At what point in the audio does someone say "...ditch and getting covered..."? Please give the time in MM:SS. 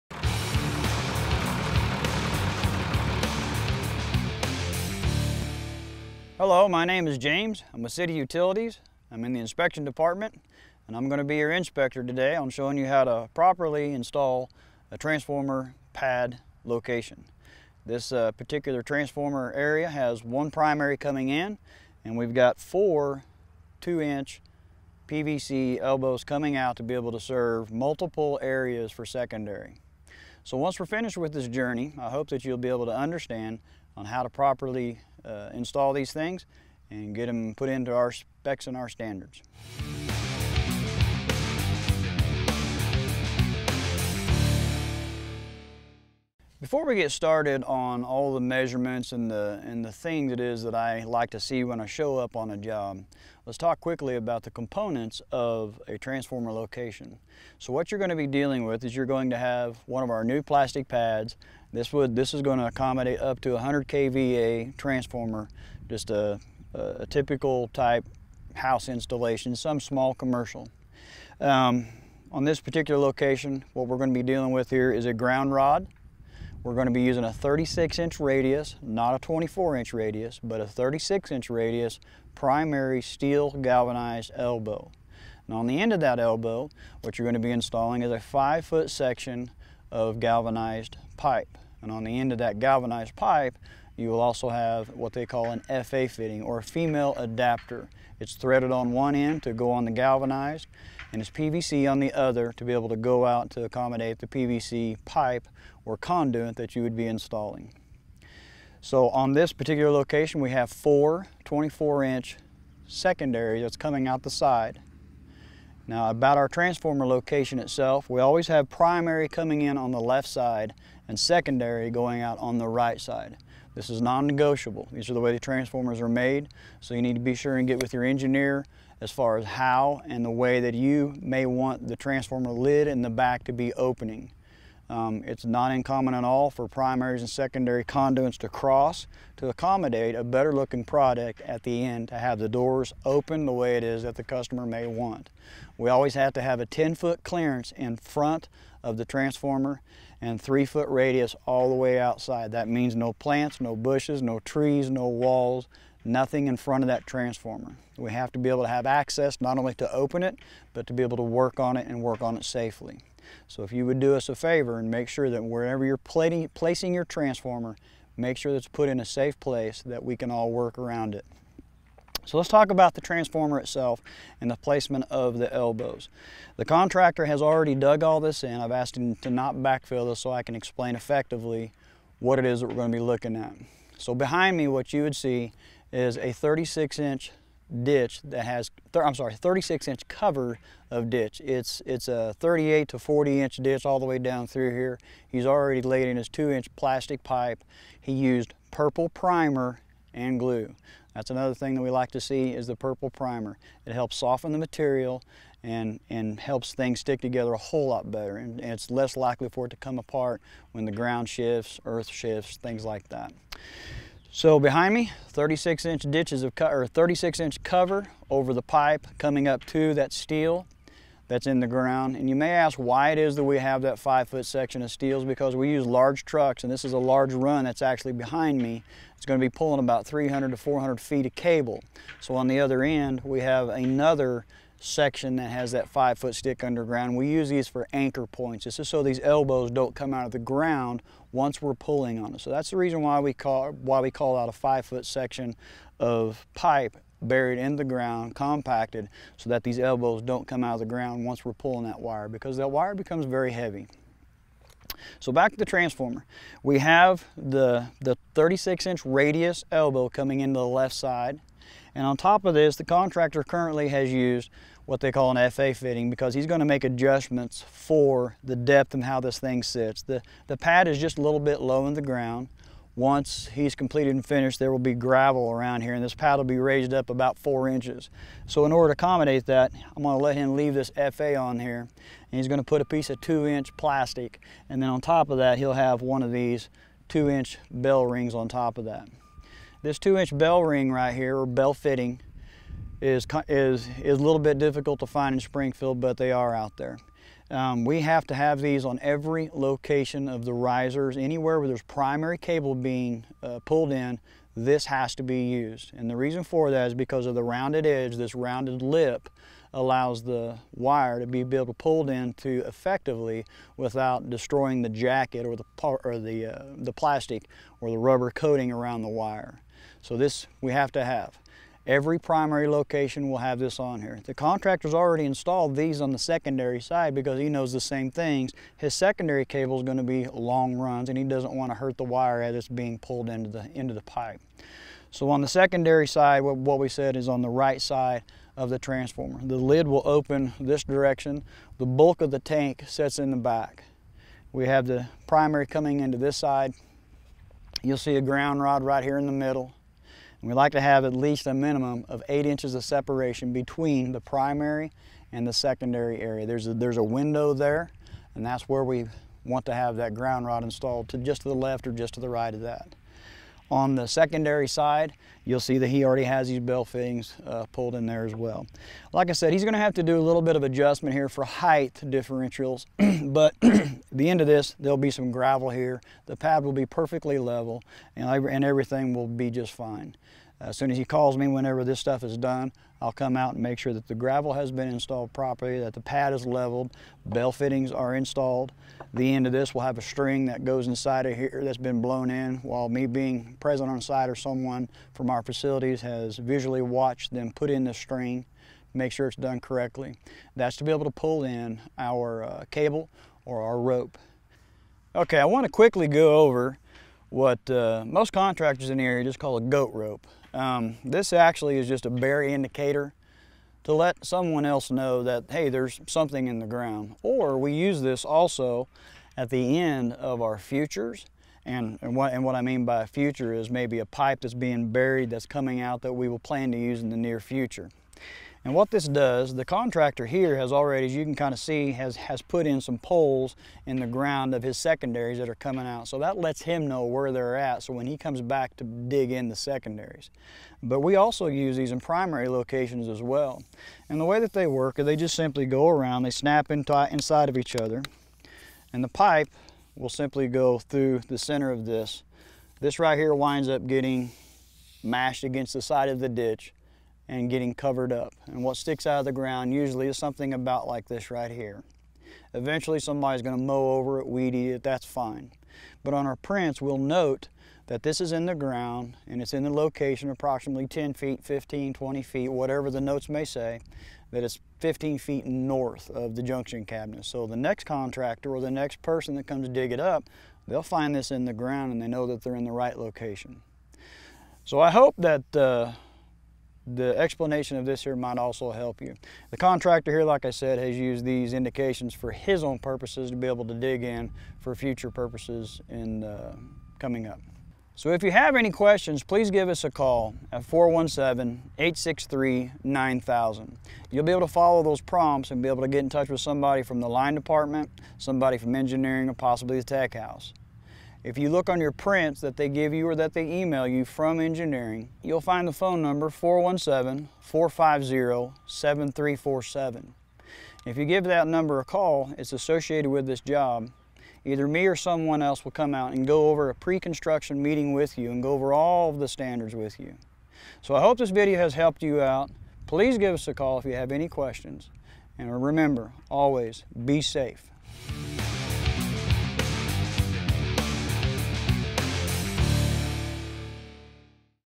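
07:36.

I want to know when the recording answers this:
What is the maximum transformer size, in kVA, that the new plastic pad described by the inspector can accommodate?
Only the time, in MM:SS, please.
01:03.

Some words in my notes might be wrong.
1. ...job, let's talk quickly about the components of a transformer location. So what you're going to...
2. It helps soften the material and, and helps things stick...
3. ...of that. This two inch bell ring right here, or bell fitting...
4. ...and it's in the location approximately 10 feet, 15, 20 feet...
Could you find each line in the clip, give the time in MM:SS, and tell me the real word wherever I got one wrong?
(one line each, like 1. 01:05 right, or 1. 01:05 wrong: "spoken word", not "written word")
1. 00:52 right
2. 03:23 right
3. 04:48 right
4. 07:49 right.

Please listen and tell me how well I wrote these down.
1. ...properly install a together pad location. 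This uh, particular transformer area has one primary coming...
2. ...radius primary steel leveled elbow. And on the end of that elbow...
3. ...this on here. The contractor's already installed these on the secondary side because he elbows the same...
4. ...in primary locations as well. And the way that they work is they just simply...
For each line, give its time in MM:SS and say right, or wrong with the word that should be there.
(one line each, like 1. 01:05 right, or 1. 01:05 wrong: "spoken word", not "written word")
1. 00:13 wrong: "transformer", not "together"
2. 01:21 wrong: "galvanized", not "leveled"
3. 05:23 wrong: "knows", not "elbows"
4. 07:21 right.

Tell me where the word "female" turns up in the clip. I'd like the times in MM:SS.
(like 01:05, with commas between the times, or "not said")
01:36.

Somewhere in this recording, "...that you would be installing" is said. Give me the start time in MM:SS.
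01:46.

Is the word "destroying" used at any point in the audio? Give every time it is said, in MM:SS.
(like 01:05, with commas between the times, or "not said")
05:14.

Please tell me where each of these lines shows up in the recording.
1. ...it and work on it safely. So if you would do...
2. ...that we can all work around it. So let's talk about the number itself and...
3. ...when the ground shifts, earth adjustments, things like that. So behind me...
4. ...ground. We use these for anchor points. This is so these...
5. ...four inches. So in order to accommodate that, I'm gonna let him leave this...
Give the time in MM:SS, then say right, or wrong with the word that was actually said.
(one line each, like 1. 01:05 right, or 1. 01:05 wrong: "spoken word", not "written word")
1. 02:41 right
2. 02:49 wrong: "transformer", not "number"
3. 03:30 wrong: "shifts", not "adjustments"
4. 03:56 wrong: "underground", not "ground"
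5. 04:37 right.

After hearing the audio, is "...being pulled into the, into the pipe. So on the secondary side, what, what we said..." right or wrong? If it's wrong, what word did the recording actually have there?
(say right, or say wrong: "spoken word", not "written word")
right.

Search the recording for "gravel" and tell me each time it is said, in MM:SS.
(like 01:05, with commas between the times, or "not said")
04:34, 06:15, 06:24.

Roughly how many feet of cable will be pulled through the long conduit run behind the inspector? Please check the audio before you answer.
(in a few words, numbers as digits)
300 to 400 feet.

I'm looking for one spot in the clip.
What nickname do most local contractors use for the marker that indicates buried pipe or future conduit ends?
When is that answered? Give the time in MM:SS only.
06:49.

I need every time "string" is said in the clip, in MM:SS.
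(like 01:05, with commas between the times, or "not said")
06:30, 06:37.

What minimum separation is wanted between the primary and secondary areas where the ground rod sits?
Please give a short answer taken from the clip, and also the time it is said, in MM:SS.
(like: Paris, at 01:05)
8 inches, at 05:52.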